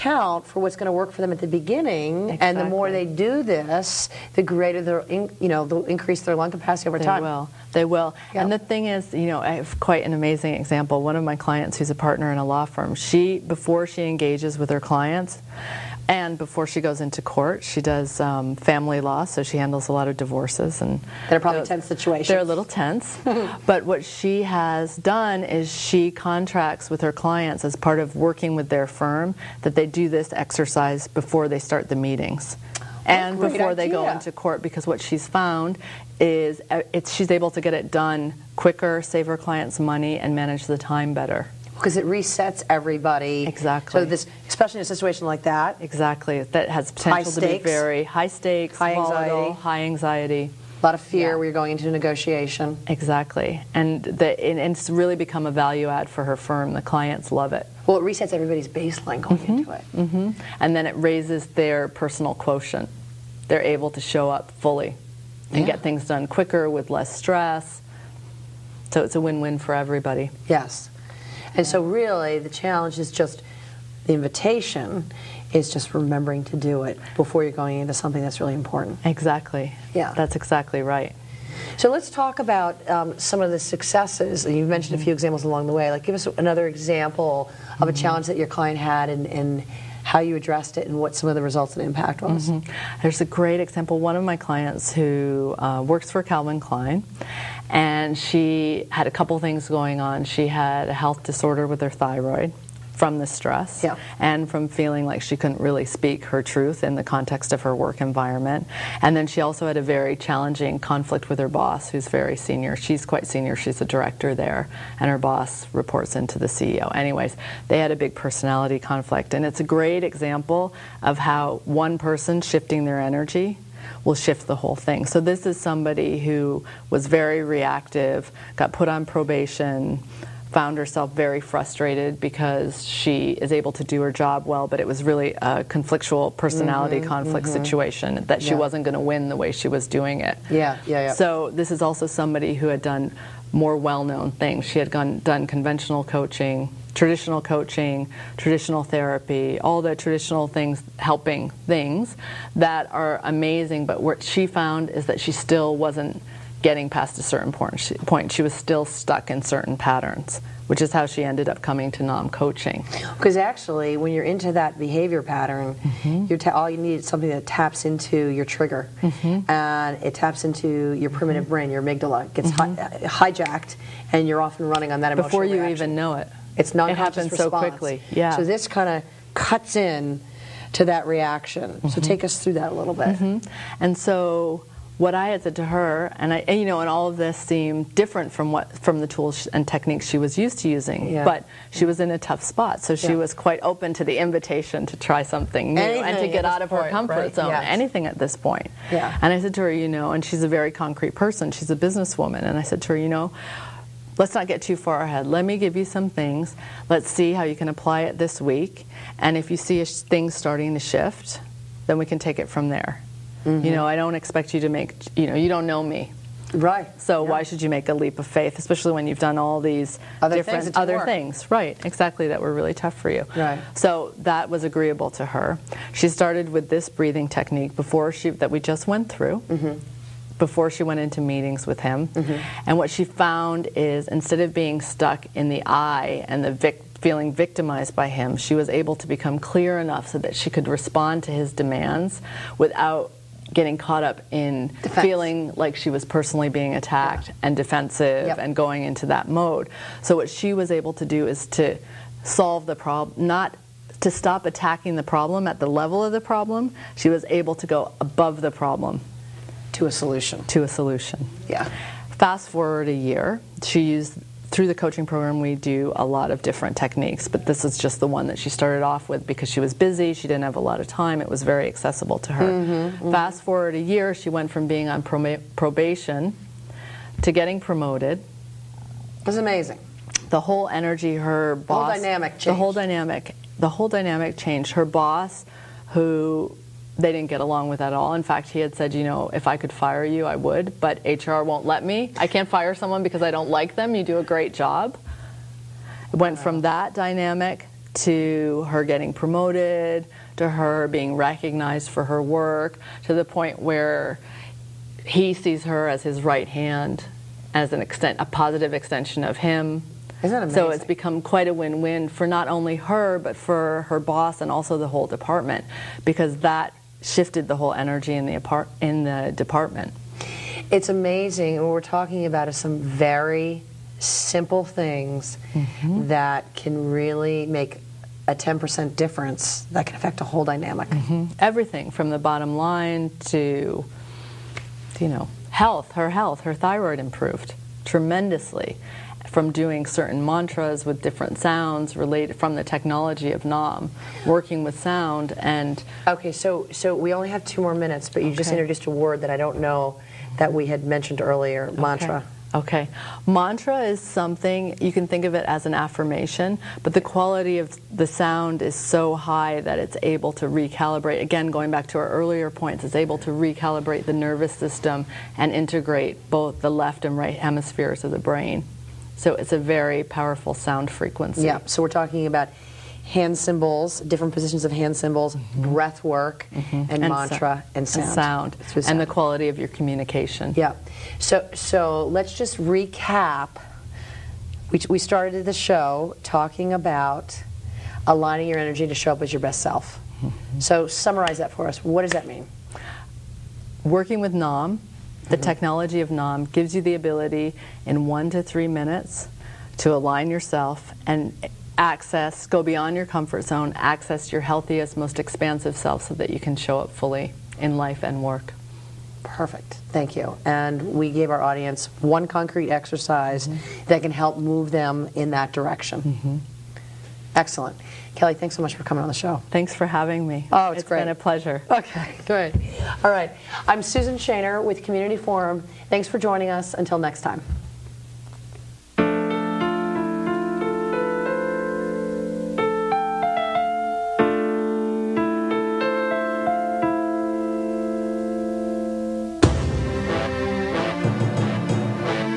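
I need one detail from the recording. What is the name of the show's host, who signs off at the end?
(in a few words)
Susan Shaner.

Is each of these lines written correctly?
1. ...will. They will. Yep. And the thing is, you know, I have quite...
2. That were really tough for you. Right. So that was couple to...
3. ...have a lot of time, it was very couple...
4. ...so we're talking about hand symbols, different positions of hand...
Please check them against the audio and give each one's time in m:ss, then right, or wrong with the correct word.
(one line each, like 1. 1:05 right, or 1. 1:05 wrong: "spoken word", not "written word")
1. 0:07 right
2. 3:42 wrong: "agreeable", not "couple"
3. 4:30 wrong: "accessible", not "couple"
4. 6:11 right.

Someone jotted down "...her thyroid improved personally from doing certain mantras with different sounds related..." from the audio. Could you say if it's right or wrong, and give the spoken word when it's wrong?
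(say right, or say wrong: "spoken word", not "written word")
wrong: "tremendously", not "personally".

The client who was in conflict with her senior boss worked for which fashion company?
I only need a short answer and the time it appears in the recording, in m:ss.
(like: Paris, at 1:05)
Calvin Klein, at 1:36.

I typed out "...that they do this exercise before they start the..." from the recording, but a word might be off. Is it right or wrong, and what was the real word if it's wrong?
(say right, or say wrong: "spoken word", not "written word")
right.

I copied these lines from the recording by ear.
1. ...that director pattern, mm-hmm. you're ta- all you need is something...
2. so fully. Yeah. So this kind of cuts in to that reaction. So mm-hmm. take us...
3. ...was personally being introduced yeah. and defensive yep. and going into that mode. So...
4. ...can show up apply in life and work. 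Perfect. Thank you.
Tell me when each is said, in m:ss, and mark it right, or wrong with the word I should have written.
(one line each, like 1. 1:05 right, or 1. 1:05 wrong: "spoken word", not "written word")
1. 2:44 wrong: "behavior", not "director"
2. 2:57 wrong: "quickly", not "fully"
3. 4:05 wrong: "attacked", not "introduced"
4. 6:46 wrong: "fully", not "apply".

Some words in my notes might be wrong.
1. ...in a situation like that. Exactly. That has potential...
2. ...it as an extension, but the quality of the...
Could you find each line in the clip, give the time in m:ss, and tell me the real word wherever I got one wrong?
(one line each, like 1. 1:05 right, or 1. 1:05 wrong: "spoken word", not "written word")
1. 0:44 right
2. 5:55 wrong: "affirmation", not "extension".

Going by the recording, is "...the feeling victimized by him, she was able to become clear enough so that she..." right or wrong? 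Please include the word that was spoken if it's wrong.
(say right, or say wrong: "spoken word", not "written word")
right.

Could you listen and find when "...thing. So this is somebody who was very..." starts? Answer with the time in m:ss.
2:04.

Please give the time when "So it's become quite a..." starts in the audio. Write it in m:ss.
5:10.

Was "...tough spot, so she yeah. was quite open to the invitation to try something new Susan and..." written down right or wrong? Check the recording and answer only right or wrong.
wrong.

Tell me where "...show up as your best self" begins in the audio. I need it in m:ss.
6:28.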